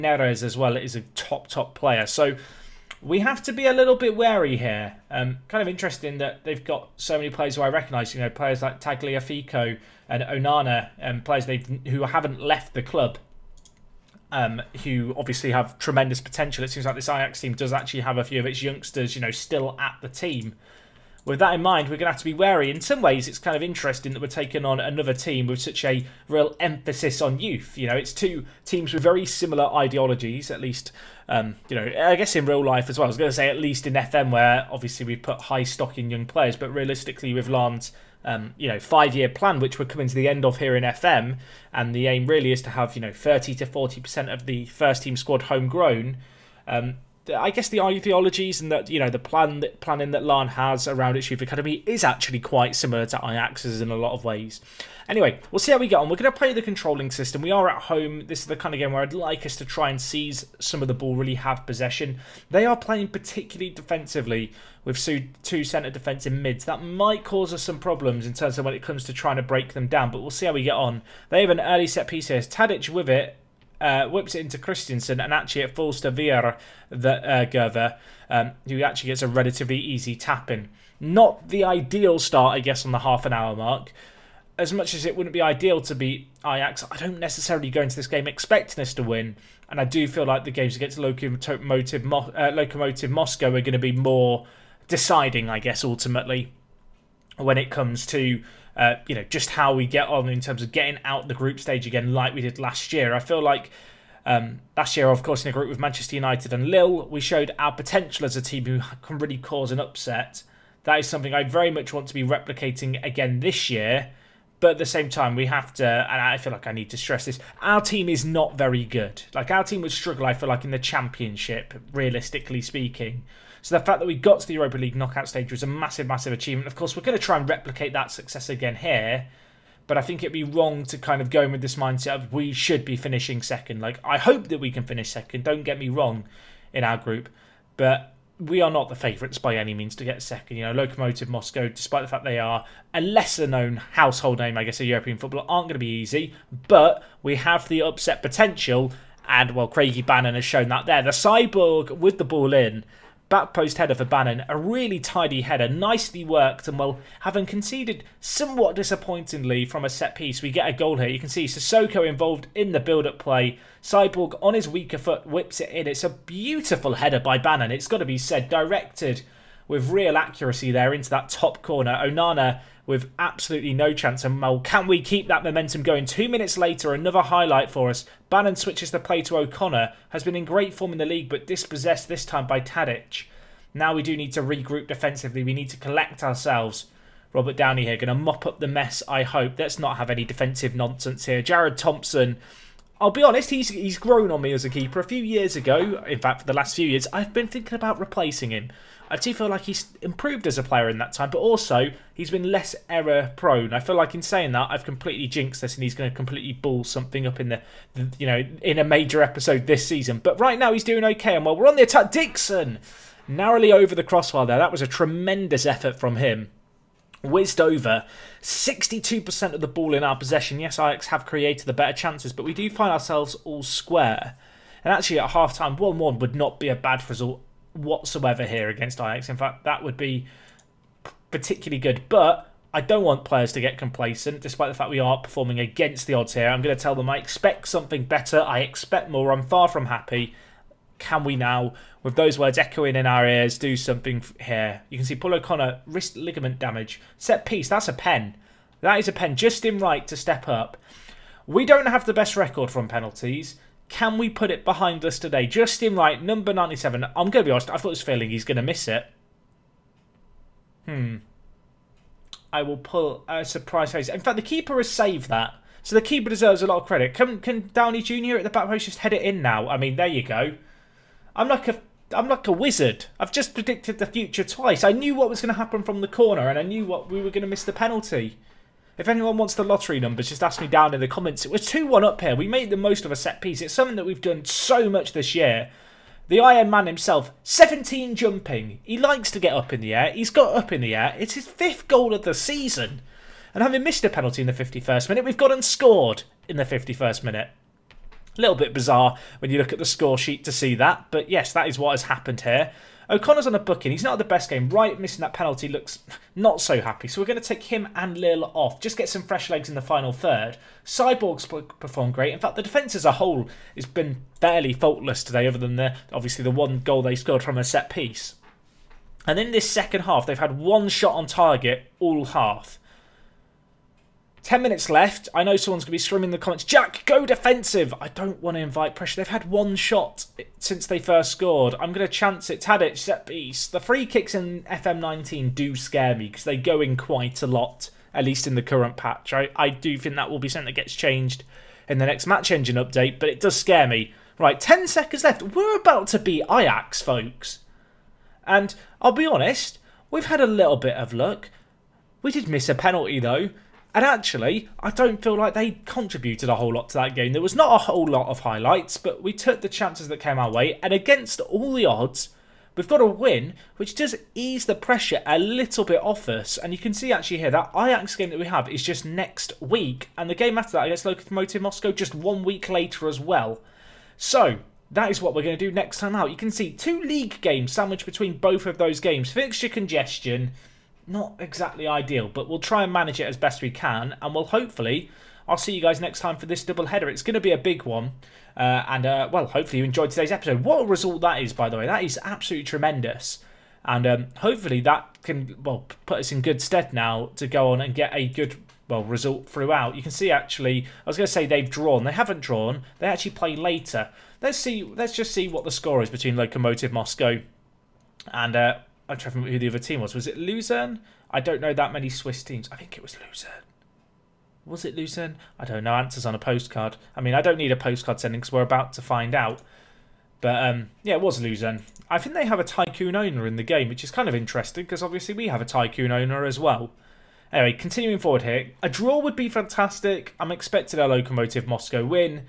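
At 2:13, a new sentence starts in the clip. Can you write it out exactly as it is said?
Like, I hope that we can finish second, don't get me wrong, in our group.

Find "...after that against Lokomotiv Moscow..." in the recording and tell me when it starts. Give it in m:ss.
6:10.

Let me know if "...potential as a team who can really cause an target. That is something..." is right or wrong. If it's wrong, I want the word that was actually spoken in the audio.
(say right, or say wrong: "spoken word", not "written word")
wrong: "upset", not "target".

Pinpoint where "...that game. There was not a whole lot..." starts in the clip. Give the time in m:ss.
5:56.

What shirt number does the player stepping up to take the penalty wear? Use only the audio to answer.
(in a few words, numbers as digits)
97.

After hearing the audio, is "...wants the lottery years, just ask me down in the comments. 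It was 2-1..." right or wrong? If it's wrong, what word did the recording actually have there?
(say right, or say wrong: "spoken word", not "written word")
wrong: "numbers", not "years".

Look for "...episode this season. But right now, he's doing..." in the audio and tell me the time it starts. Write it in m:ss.
3:29.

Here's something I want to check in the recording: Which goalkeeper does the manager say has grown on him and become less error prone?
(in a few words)
Jared Thompson.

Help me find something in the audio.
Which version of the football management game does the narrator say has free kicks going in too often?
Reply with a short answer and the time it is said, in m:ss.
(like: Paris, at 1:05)
FM19, at 5:34.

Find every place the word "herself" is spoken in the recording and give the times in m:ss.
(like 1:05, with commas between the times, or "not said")
not said.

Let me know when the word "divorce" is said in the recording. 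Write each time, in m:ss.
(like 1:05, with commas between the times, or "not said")
not said.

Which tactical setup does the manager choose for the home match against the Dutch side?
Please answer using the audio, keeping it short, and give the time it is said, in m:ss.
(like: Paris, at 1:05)
controlling system, at 0:56.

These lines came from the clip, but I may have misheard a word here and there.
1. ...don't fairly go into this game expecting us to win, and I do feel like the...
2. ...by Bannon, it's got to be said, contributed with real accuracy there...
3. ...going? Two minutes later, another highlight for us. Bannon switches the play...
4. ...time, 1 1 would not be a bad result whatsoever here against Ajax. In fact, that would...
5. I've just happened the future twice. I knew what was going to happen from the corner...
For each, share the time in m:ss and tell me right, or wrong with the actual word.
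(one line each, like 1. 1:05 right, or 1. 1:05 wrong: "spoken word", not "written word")
1. 1:26 wrong: "necessarily", not "fairly"
2. 2:47 wrong: "directed", not "contributed"
3. 2:55 right
4. 3:45 right
5. 4:33 wrong: "predicted", not "happened".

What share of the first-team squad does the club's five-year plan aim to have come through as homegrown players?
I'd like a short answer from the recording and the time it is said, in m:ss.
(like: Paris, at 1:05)
30 to 40 percent, at 0:43.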